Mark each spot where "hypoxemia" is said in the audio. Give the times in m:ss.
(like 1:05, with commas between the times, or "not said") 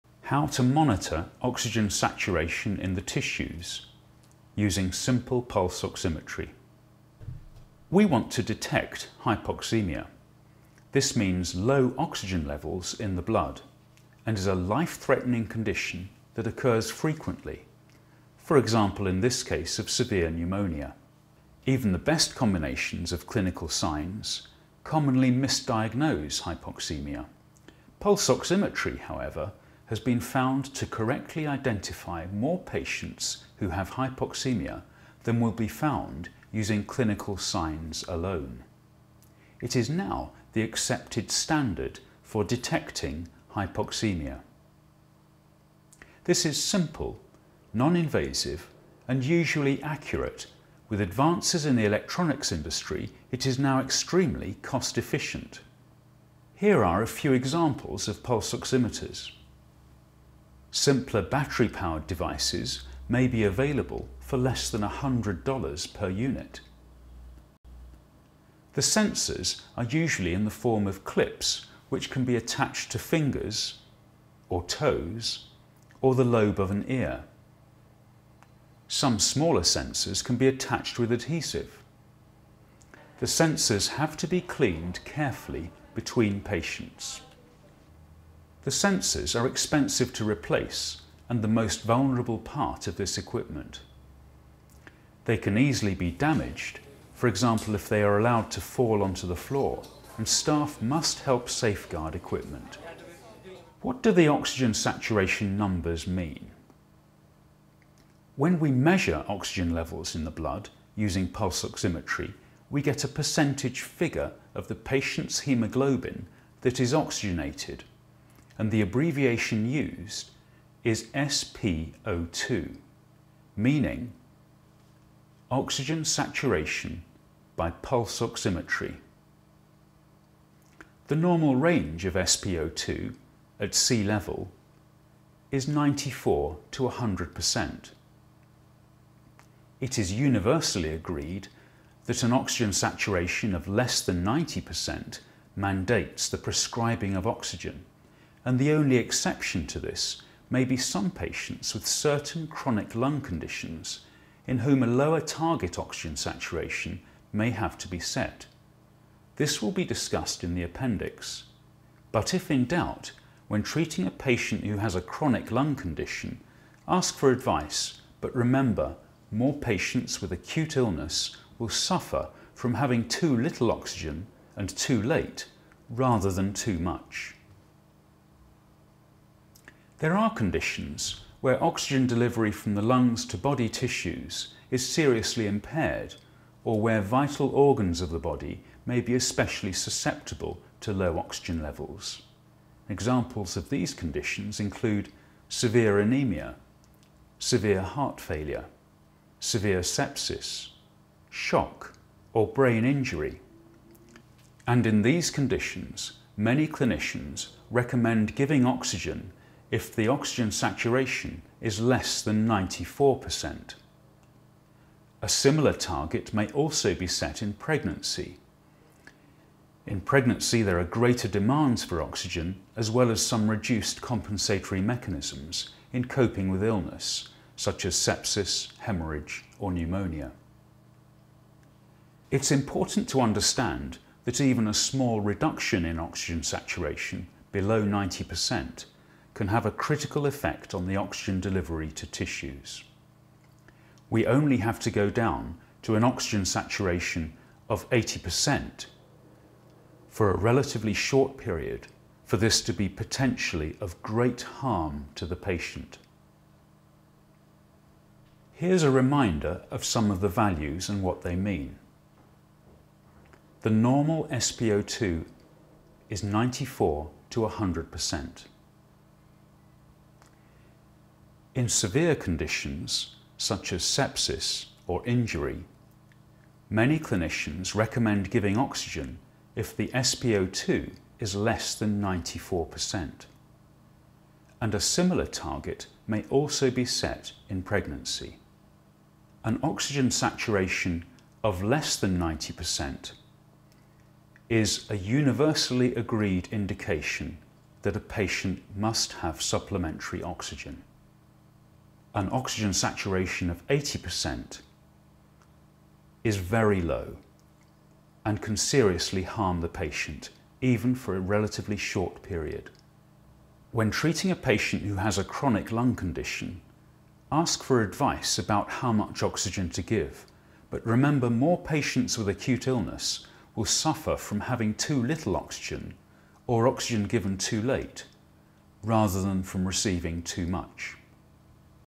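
0:09, 0:26, 0:33, 0:43.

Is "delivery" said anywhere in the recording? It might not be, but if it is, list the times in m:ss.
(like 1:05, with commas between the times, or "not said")
3:02, 4:01.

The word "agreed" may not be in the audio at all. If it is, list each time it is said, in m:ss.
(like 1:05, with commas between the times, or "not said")
2:20, 4:55.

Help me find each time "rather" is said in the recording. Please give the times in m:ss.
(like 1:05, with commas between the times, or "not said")
2:55, 5:28.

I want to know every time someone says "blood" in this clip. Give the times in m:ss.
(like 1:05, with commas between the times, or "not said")
0:13, 1:50.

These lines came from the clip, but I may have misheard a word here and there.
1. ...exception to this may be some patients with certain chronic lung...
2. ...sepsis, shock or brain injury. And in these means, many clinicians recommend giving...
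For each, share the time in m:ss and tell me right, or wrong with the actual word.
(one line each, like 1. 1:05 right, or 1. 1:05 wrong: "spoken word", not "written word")
1. 2:28 right
2. 3:19 wrong: "conditions", not "means".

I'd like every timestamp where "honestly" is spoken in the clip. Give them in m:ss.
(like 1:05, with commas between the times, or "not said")
not said.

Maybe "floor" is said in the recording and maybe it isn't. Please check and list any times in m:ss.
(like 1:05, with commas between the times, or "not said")
1:39.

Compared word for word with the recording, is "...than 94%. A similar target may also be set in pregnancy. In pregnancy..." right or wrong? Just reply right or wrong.
right.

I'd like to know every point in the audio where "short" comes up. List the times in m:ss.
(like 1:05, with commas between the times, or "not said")
4:10, 5:11.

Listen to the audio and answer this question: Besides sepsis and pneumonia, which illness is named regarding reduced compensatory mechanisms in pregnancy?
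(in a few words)
hemorrhage.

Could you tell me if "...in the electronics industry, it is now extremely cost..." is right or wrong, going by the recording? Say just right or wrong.
right.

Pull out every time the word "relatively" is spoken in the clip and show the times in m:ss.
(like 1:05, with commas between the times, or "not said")
4:10, 5:11.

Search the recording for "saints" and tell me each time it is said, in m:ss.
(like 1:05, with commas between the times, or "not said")
not said.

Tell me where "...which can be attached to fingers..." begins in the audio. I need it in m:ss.
1:11.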